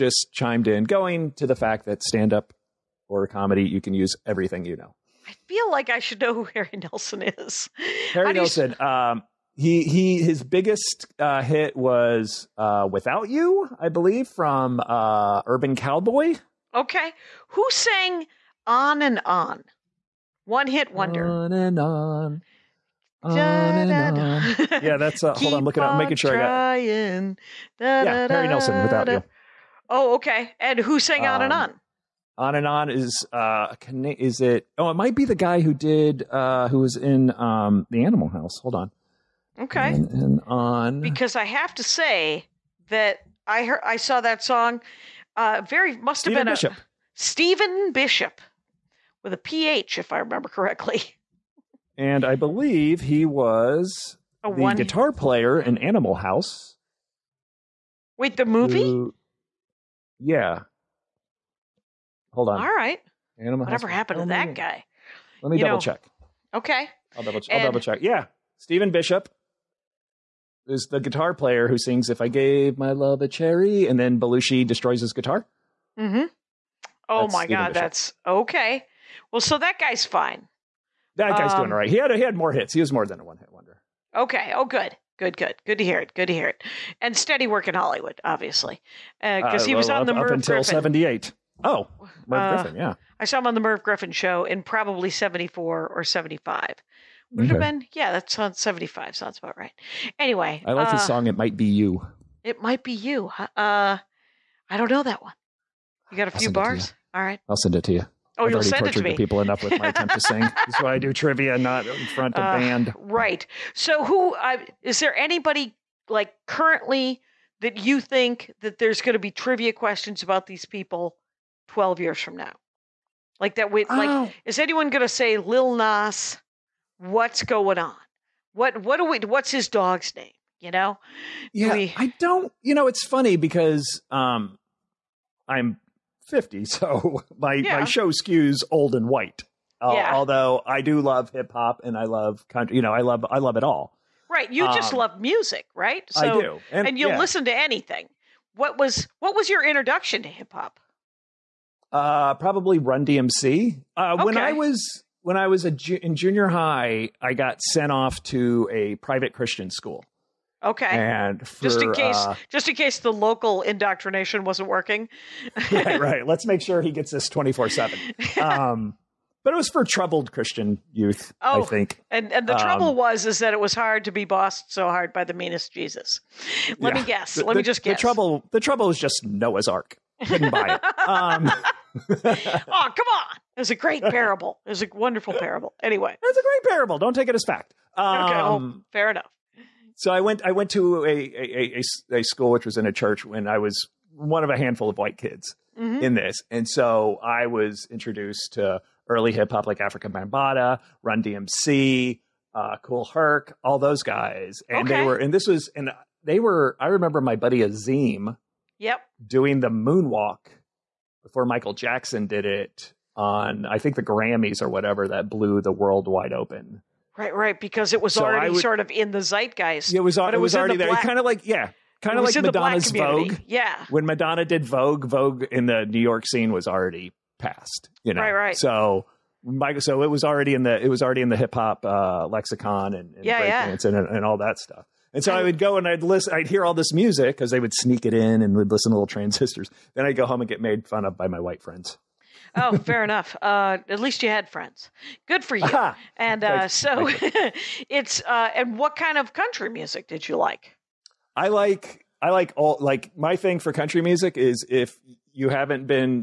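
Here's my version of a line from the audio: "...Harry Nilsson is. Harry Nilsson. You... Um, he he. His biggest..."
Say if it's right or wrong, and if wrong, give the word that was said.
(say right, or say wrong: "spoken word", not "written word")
right.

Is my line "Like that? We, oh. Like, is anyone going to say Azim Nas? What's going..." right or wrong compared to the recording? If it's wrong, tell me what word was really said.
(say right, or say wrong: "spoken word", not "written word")
wrong: "Lil", not "Azim".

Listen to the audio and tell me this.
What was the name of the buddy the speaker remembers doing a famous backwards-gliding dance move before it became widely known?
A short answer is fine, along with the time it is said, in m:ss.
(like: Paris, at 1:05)
Azim, at 3:27.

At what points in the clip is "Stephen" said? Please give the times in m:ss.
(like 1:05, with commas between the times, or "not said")
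0:47, 1:08, 1:17.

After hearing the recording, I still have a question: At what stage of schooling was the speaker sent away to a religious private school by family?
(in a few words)
junior high.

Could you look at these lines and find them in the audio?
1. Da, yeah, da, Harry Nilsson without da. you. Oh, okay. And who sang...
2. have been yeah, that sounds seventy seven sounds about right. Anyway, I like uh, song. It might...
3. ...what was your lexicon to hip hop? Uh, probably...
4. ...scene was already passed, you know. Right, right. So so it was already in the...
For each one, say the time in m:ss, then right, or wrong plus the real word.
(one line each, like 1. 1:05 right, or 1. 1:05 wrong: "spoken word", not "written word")
1. 0:27 right
2. 1:37 wrong: "five", not "seven"
3. 2:29 wrong: "introduction", not "lexicon"
4. 3:46 right.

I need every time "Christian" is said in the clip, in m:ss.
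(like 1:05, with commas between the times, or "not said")
2:39, 2:50.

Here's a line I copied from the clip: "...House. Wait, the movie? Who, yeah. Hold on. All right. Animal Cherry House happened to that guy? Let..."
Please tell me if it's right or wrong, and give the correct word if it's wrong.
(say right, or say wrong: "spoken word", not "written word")
wrong: "Whatever", not "Cherry".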